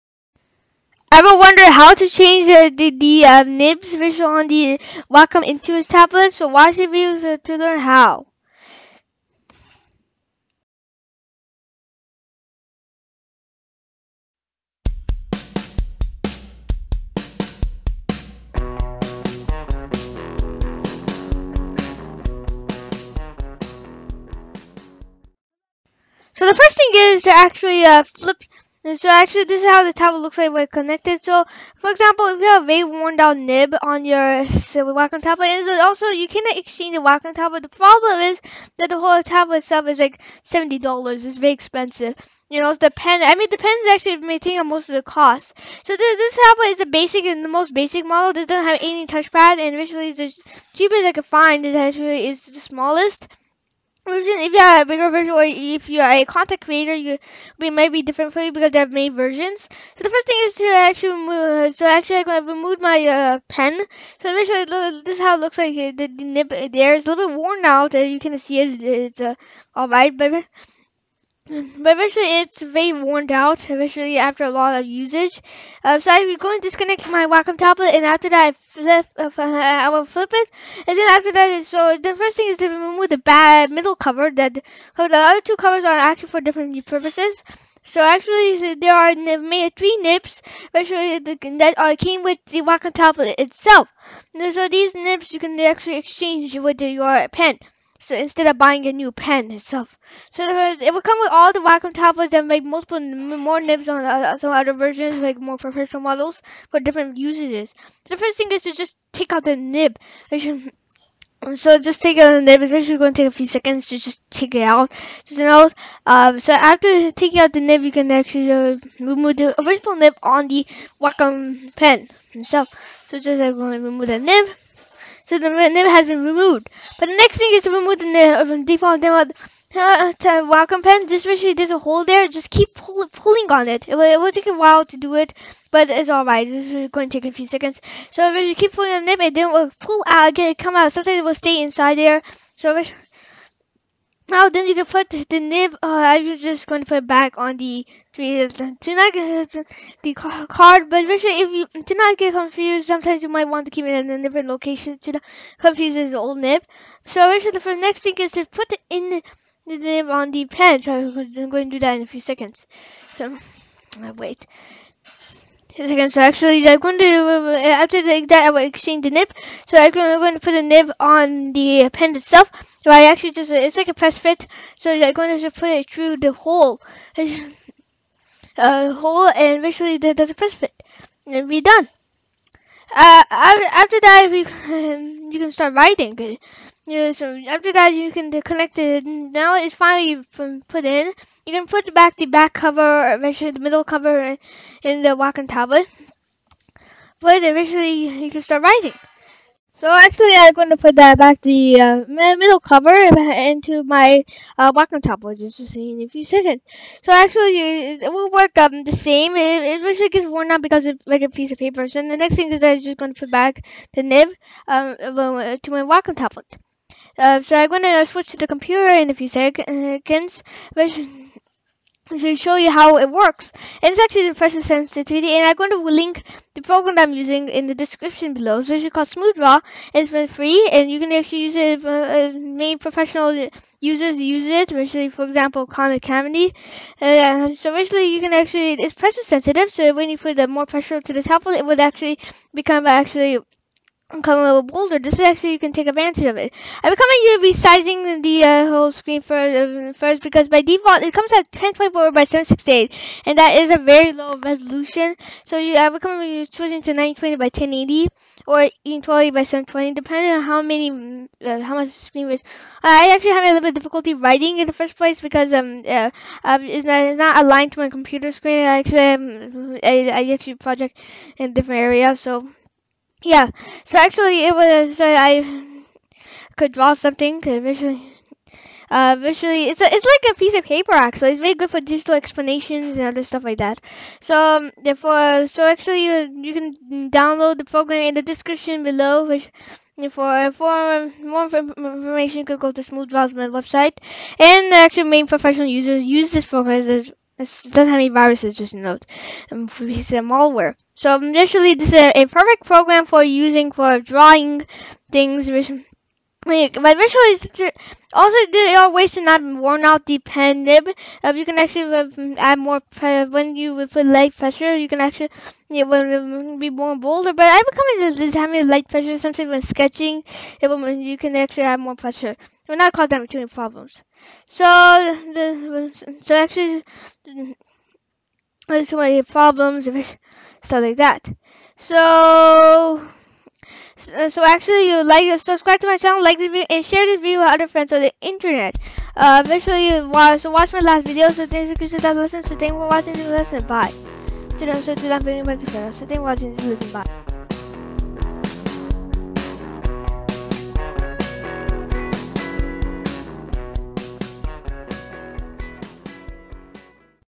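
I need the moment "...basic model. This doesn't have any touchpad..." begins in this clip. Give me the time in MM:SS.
00:47.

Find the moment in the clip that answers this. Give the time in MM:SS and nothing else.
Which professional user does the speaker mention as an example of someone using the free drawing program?
03:55.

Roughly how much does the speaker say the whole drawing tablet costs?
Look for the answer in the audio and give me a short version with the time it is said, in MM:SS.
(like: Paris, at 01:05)
$70, at 00:40.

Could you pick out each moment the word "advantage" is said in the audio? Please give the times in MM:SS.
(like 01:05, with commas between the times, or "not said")
04:05.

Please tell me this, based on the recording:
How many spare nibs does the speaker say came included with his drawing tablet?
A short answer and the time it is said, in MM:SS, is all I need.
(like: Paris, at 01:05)
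3, at 01:29.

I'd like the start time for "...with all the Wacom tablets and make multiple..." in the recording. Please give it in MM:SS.
01:41.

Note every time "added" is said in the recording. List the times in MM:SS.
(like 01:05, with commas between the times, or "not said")
not said.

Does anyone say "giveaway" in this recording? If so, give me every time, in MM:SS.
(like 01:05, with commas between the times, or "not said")
not said.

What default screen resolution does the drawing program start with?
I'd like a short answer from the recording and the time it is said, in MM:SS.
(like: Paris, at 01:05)
1024 by 768, at 04:11.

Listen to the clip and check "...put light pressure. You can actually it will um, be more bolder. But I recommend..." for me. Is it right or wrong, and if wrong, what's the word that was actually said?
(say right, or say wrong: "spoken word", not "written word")
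right.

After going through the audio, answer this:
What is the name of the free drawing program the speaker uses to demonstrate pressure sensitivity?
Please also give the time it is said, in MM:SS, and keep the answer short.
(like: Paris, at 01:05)
SmoothDraw, at 03:49.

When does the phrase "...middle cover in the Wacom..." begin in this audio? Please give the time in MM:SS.
03:13.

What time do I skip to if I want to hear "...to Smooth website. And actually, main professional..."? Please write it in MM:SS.
04:52.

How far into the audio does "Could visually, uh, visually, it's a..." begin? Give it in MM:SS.
04:37.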